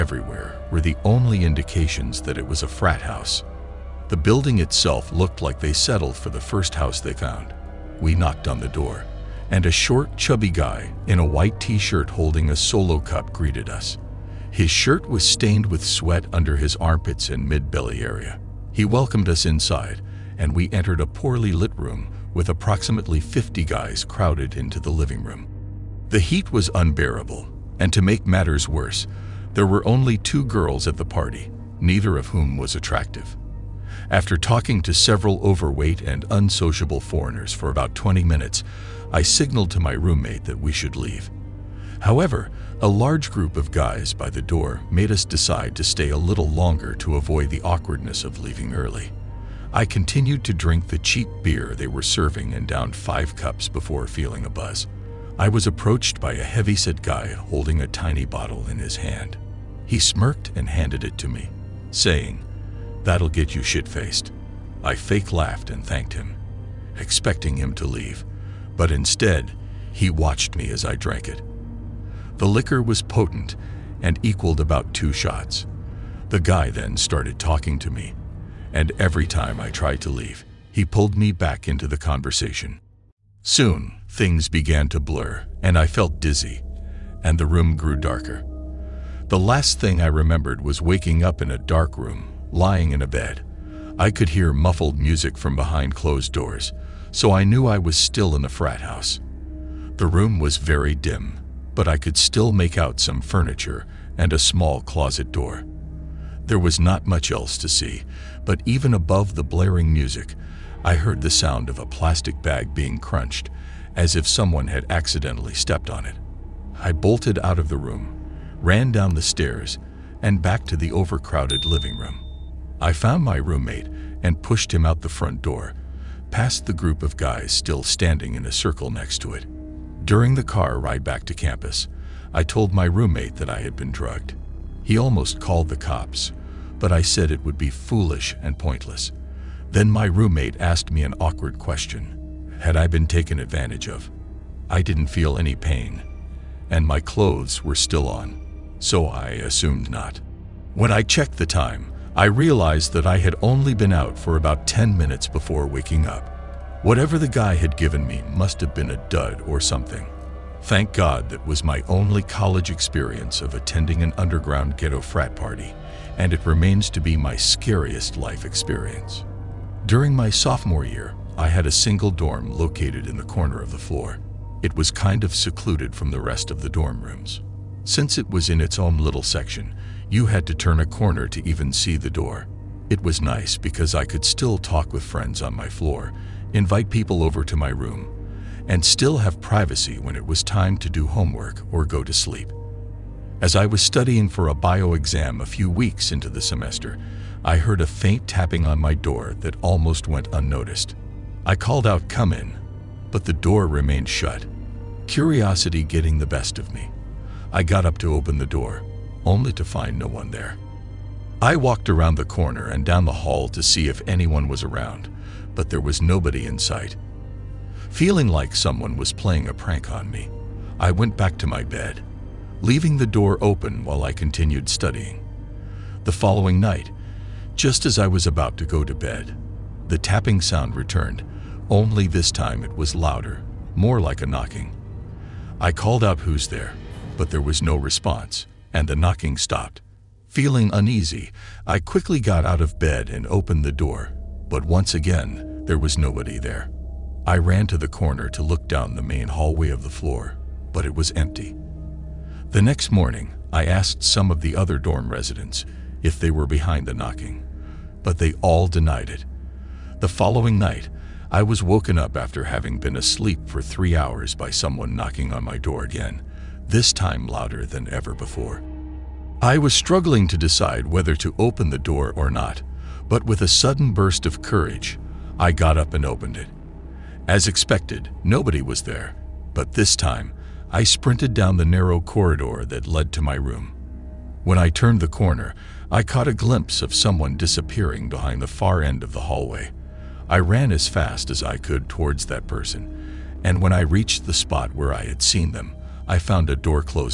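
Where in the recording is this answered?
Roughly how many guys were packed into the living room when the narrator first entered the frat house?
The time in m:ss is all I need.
0:22.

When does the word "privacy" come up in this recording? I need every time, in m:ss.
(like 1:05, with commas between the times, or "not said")
3:09.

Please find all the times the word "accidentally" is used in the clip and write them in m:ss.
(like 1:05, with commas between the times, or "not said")
1:54.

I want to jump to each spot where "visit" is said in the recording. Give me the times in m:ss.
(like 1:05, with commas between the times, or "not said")
not said.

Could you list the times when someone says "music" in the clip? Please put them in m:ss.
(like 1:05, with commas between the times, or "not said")
1:34, 1:49.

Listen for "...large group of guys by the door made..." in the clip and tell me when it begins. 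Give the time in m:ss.
0:42.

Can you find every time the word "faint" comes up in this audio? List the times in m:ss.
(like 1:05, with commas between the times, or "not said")
3:17.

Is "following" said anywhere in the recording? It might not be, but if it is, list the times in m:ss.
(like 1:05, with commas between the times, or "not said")
3:46, 4:20.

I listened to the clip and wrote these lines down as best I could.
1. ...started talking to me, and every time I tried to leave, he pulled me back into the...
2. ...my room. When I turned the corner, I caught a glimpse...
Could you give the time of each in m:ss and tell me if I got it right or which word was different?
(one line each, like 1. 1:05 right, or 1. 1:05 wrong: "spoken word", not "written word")
1. 1:16 right
2. 4:43 right.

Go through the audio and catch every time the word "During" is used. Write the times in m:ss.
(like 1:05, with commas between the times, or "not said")
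2:10, 2:49.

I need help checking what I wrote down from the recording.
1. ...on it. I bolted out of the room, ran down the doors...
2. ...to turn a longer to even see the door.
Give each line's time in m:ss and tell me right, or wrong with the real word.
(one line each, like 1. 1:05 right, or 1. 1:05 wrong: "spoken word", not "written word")
1. 1:55 wrong: "stairs", not "doors"
2. 3:00 wrong: "corner", not "longer".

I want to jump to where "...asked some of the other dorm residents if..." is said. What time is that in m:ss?
4:13.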